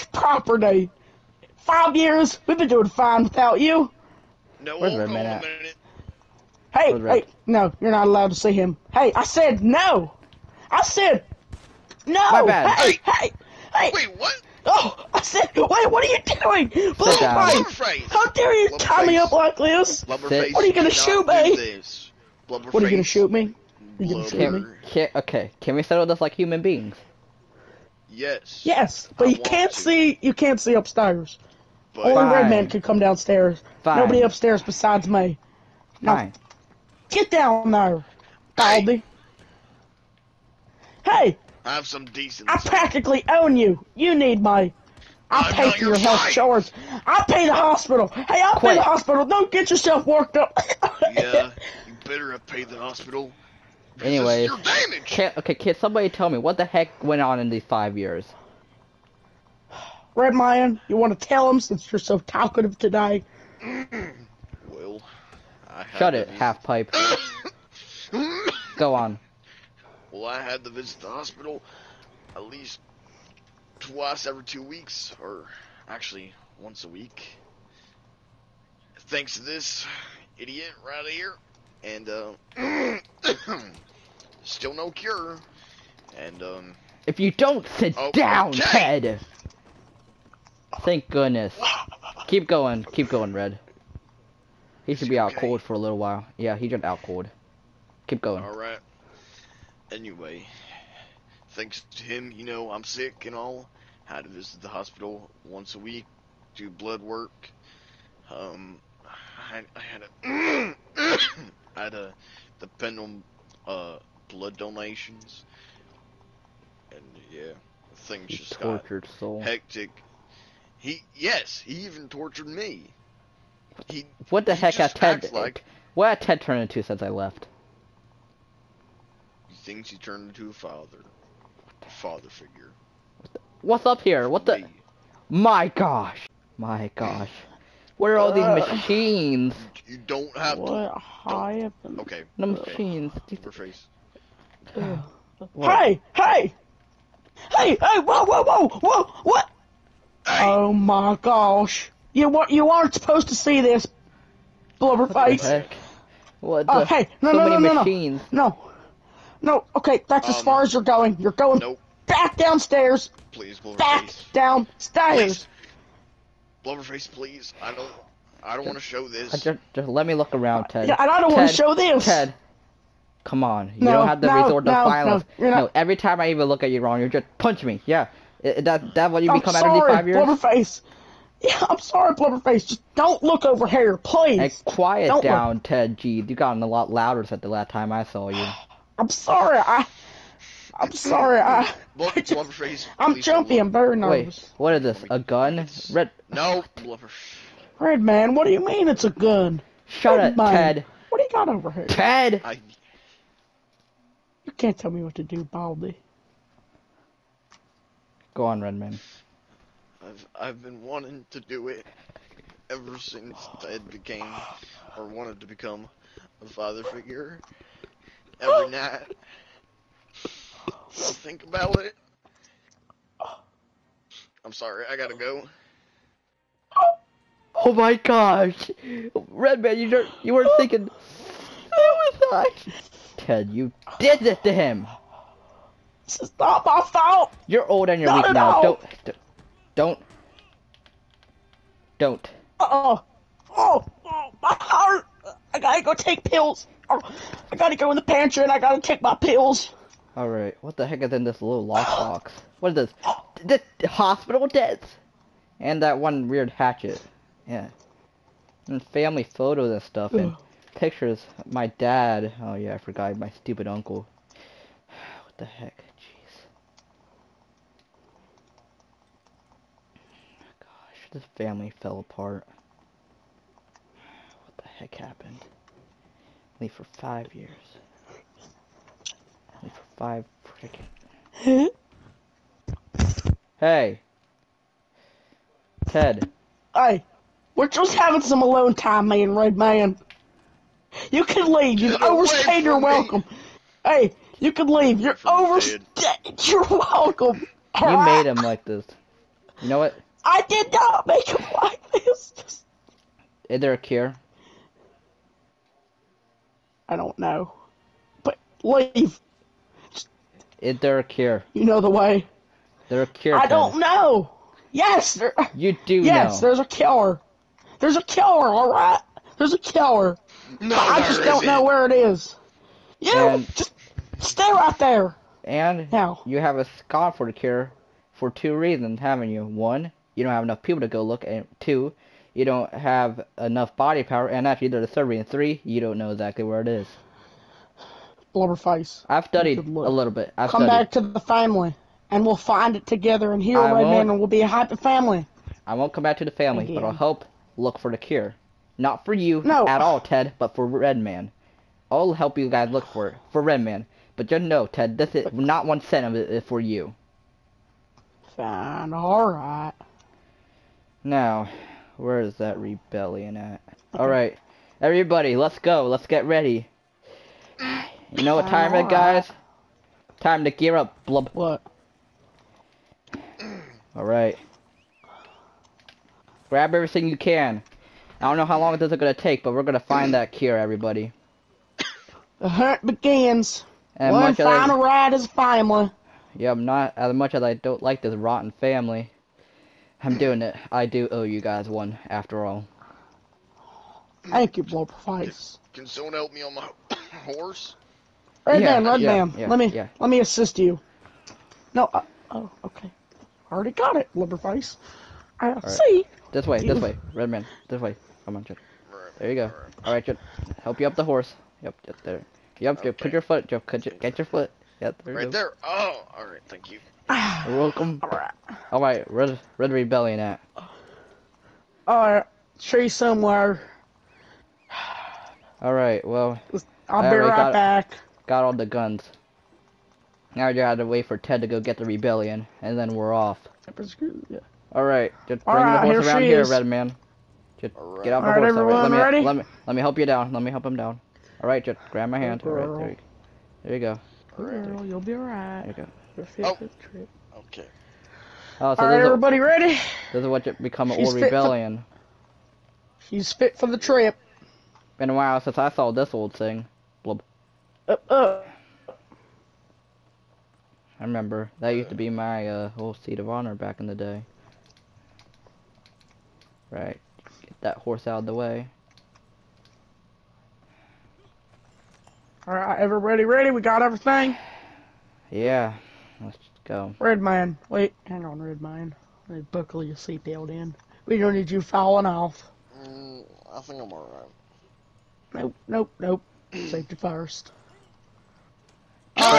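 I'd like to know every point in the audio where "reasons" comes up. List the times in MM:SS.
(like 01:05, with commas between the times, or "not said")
05:28, 05:35.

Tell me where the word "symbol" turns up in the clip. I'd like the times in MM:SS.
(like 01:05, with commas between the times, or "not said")
not said.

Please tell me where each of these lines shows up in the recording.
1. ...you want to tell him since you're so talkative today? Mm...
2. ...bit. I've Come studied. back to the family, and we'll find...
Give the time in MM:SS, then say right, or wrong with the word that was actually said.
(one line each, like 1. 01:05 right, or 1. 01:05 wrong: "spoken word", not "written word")
1. 01:00 right
2. 05:40 right.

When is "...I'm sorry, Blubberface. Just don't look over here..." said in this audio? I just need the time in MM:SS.
03:01.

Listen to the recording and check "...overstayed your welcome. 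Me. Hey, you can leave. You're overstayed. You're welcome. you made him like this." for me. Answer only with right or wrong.
right.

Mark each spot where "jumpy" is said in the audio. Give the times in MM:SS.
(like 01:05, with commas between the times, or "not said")
03:13.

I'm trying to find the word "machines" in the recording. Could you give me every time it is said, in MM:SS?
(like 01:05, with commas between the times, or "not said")
02:18, 02:22, 02:37.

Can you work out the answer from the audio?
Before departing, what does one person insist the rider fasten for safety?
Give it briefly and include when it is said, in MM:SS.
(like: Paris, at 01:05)
Seatbelt, at 07:59.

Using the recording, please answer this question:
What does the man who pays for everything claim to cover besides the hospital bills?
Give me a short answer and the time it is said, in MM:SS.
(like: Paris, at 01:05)
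Health insurance, at 00:45.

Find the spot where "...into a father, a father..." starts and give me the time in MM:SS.
02:10.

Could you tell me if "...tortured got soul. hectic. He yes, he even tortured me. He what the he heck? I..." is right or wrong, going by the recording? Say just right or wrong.
right.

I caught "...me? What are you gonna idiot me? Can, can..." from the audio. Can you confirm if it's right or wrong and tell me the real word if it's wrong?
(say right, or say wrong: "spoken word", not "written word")
wrong: "shoot", not "idiot".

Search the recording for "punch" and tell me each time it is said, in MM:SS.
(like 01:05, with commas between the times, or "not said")
02:57.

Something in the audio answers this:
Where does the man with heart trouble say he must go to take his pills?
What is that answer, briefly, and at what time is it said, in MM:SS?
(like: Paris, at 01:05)
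The pantry, at 04:07.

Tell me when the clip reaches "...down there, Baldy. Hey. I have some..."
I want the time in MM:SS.
00:37.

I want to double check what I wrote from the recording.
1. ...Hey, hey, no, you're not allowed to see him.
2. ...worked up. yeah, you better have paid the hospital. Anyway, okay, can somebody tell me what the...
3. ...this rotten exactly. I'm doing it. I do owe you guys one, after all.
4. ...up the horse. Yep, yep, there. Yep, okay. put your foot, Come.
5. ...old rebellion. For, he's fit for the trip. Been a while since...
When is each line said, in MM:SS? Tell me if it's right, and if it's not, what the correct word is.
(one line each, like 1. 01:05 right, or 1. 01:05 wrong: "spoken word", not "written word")
1. 00:06 right
2. 00:50 right
3. 06:28 wrong: "family", not "exactly"
4. 06:50 wrong: "Joe", not "Come"
5. 07:31 right.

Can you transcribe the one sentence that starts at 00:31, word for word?
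But Only Red men could come downstairs.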